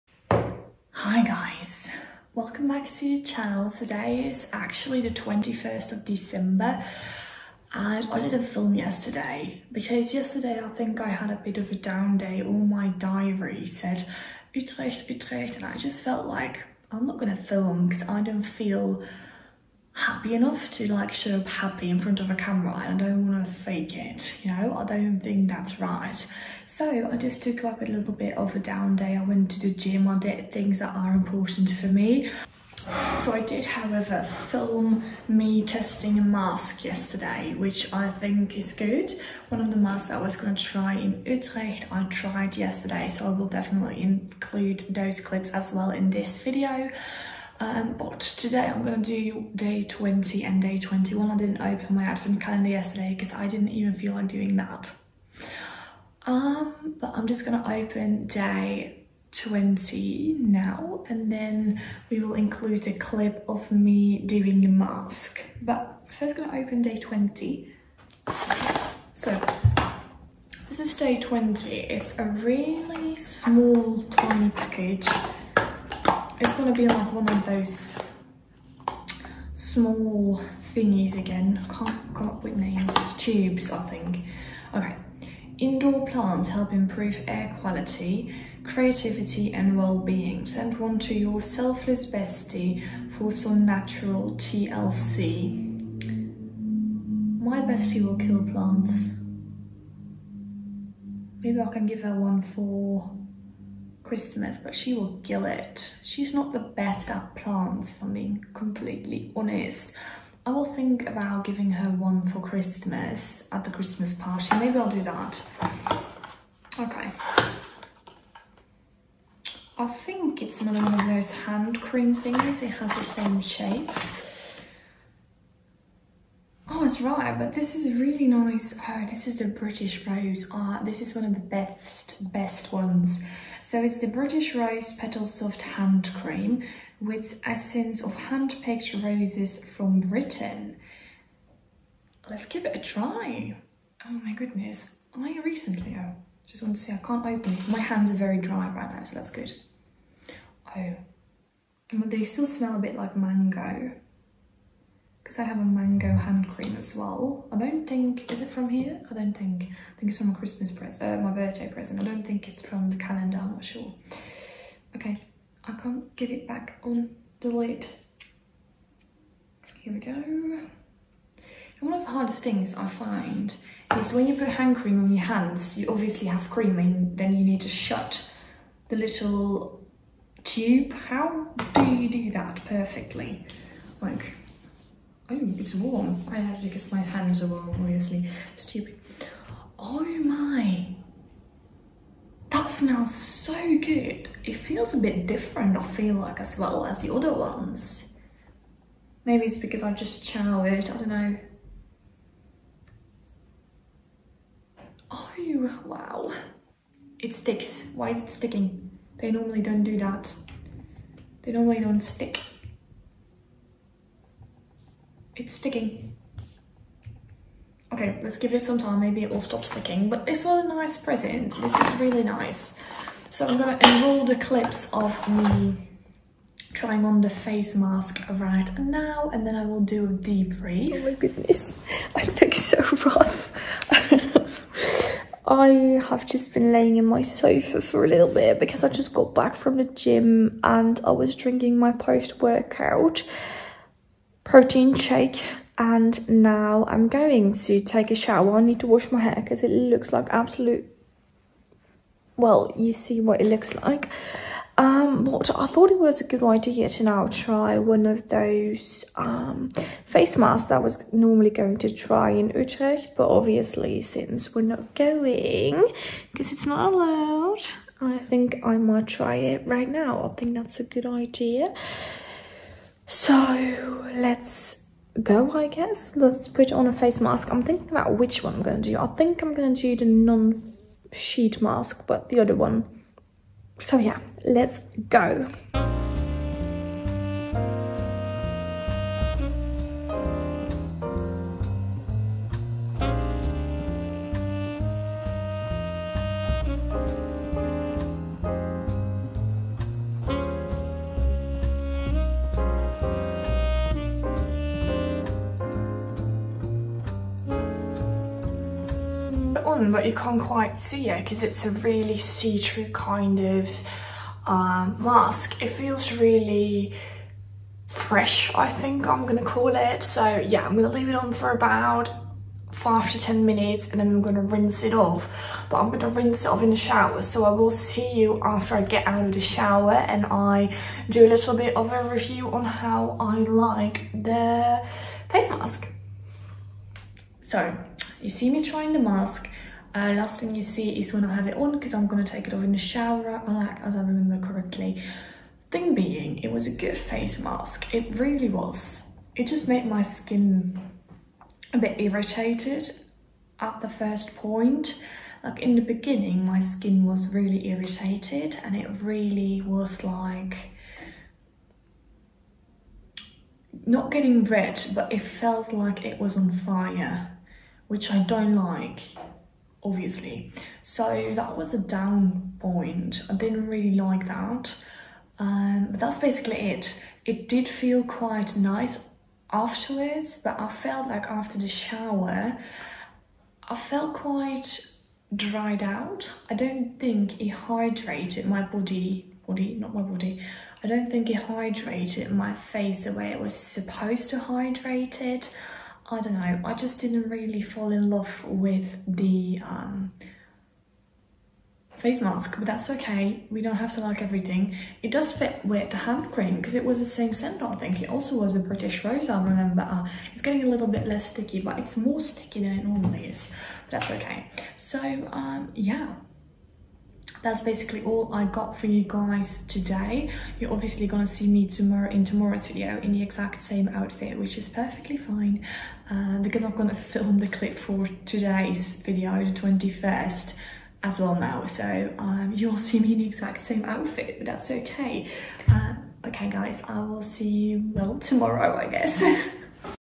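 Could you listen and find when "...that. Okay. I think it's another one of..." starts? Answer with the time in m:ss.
1:55.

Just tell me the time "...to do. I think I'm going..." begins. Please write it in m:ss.
4:38.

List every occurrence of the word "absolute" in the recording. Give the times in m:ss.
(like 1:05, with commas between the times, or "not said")
4:10.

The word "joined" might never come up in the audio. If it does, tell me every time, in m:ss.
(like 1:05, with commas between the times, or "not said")
not said.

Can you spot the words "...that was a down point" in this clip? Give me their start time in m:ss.
6:11.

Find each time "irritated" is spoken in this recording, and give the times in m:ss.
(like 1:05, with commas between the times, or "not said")
5:51, 5:57.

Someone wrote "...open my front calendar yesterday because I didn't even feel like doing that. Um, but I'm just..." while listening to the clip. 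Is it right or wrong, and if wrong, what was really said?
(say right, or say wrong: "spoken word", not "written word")
wrong: "advent", not "front".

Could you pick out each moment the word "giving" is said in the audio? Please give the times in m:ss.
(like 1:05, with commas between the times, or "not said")
1:51.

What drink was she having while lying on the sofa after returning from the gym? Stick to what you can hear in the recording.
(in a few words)
Post-workout protein shake.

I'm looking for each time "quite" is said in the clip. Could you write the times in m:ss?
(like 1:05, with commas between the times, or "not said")
5:10, 6:18, 6:24.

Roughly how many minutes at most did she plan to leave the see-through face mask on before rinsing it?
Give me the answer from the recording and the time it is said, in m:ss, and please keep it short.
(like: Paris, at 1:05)
10, at 5:23.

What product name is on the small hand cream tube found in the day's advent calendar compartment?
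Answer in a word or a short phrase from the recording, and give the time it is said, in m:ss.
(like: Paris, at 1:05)
British Rose Petal Soft Hand Cream, at 2:14.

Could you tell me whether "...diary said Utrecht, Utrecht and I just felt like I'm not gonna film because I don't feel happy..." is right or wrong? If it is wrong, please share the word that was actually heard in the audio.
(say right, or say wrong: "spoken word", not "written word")
right.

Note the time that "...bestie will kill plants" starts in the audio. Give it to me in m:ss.
1:37.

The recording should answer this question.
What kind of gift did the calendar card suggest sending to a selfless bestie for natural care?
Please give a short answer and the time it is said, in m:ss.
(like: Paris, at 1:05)
Indoor plants, at 1:25.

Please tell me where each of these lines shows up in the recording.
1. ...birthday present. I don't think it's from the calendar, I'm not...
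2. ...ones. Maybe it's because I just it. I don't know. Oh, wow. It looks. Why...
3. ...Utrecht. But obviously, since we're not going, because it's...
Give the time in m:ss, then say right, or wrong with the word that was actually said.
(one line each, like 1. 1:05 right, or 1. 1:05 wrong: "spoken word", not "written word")
1. 2:41 right
2. 3:17 wrong: "sticks", not "looks"
3. 4:22 right.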